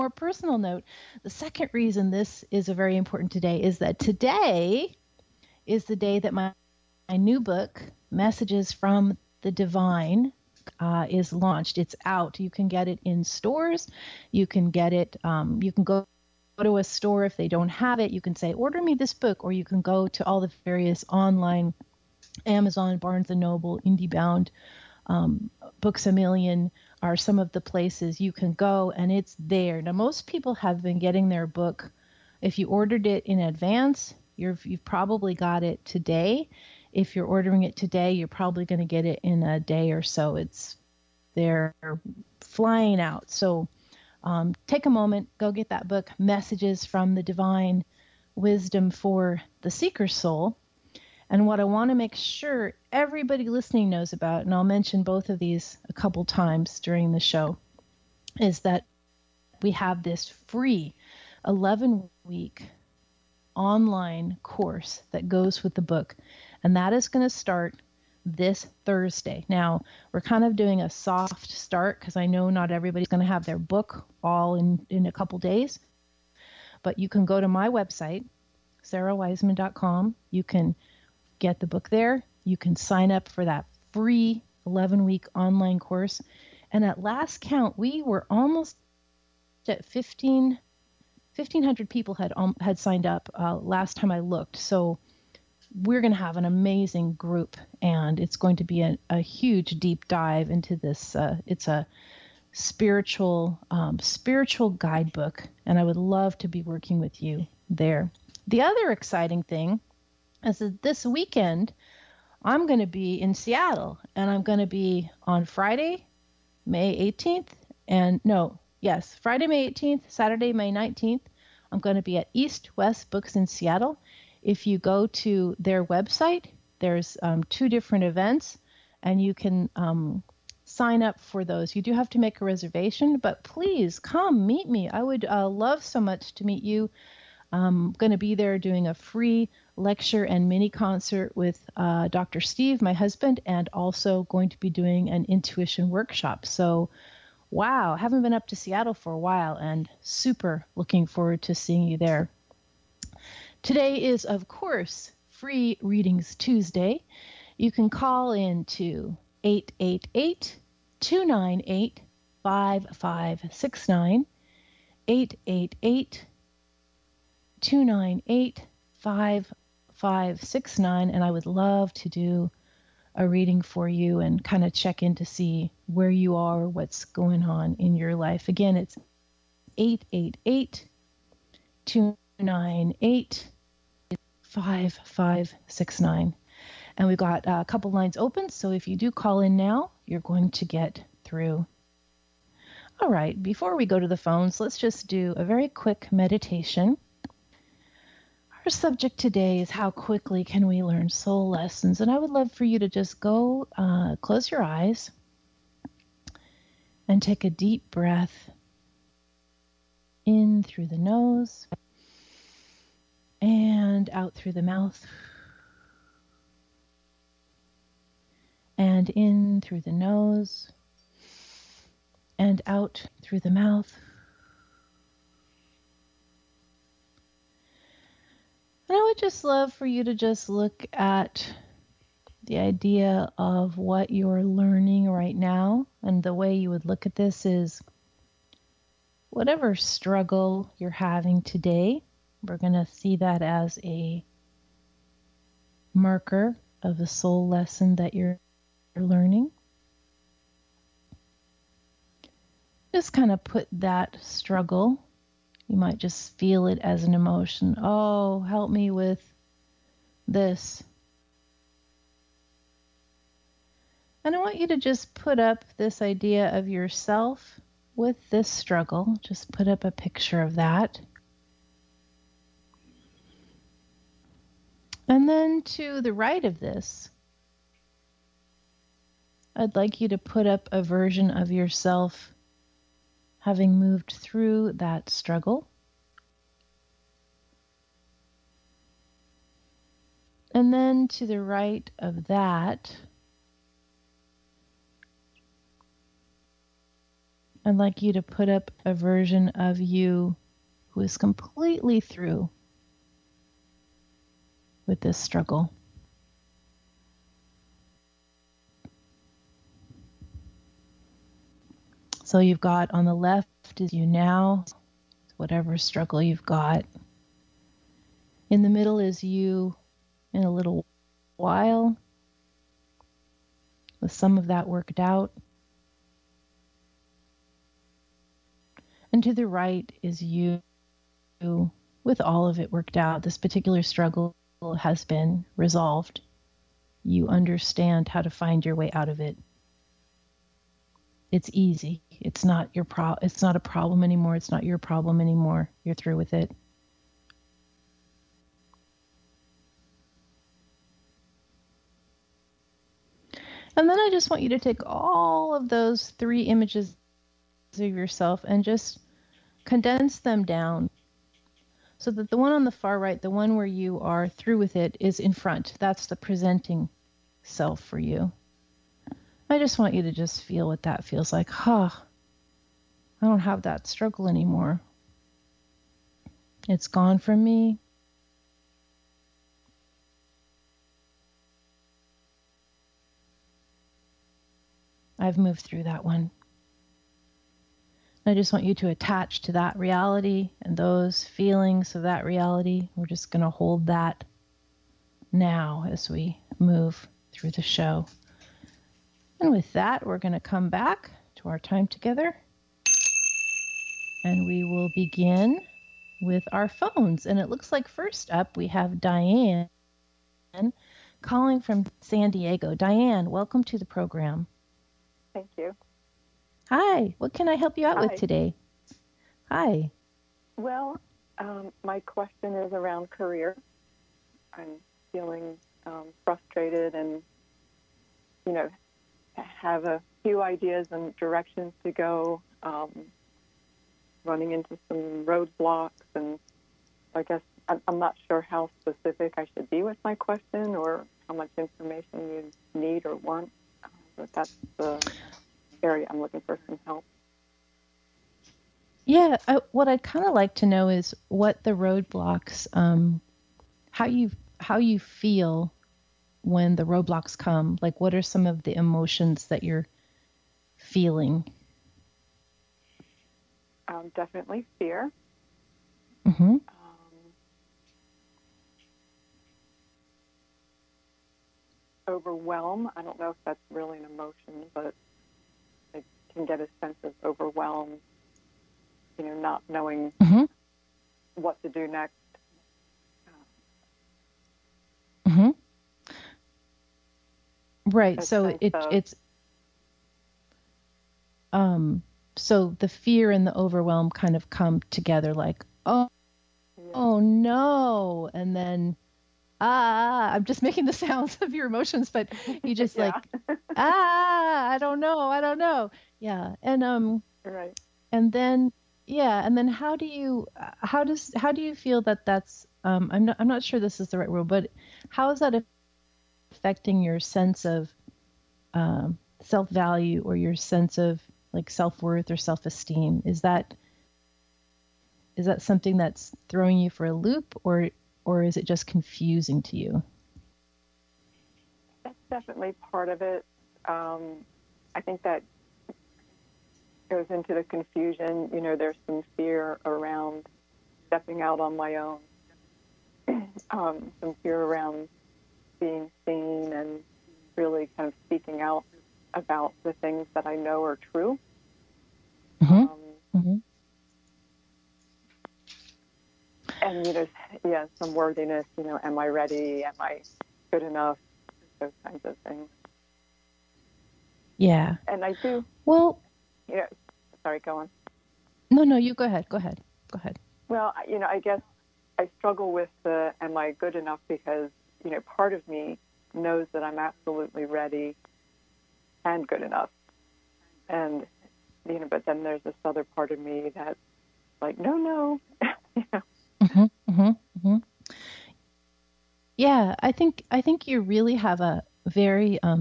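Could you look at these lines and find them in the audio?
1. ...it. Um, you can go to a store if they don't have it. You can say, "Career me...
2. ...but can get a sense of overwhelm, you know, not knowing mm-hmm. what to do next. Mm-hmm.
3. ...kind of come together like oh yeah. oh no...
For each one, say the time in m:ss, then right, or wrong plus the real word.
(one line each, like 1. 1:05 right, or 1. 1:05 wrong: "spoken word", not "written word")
1. 0:14 wrong: "Order", not "Career"
2. 7:54 right
3. 8:14 right.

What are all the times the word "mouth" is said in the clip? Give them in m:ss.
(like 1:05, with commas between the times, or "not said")
3:34, 3:43.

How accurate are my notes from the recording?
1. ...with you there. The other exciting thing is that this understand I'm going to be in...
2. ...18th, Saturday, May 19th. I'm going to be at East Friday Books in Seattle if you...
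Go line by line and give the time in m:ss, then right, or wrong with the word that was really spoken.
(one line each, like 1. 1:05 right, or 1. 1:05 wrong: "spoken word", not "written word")
1. 1:46 wrong: "weekend", not "understand"
2. 1:59 wrong: "West", not "Friday".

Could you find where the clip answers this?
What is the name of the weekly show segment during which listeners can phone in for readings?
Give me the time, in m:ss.
2:35.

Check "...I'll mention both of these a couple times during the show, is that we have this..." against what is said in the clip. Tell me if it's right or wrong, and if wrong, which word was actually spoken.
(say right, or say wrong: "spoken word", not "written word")
right.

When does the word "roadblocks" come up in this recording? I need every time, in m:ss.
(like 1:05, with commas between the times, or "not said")
7:15, 7:31, 7:36.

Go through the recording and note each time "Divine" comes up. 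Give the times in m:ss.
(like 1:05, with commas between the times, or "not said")
0:09, 0:47.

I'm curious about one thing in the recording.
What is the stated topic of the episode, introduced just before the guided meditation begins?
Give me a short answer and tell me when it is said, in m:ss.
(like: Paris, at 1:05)
how quickly can we learn soul lessons, at 3:19.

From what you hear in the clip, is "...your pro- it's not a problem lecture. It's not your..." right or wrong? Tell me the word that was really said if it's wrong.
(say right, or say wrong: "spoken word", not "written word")
wrong: "anymore", not "lecture".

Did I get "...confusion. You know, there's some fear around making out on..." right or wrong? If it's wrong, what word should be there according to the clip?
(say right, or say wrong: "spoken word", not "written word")
wrong: "stepping", not "making".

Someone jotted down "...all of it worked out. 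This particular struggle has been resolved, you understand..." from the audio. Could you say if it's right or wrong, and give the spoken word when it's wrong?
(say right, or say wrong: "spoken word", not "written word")
right.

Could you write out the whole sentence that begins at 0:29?
Now, most people have been getting their book.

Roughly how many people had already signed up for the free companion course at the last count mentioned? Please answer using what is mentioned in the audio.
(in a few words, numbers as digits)
1,500.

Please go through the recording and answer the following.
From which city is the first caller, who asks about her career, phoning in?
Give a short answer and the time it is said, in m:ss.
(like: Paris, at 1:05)
San Diego, at 6:52.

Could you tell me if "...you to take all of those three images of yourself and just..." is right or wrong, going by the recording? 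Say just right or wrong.
right.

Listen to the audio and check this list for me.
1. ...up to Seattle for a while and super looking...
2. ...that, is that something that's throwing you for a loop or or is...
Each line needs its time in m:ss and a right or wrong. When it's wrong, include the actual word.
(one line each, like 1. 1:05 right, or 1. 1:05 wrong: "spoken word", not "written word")
1. 2:28 right
2. 8:43 right.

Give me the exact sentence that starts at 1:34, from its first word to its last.
So we're going to have an amazing group, and it's going to be a, a huge deep dive into this.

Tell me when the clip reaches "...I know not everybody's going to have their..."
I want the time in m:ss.
1:12.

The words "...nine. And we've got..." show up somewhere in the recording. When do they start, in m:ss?
3:06.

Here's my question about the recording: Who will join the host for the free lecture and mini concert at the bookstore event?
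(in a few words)
Dr. Steve.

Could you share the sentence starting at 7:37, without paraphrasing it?
Like, what are some of the emotions that you're feeling?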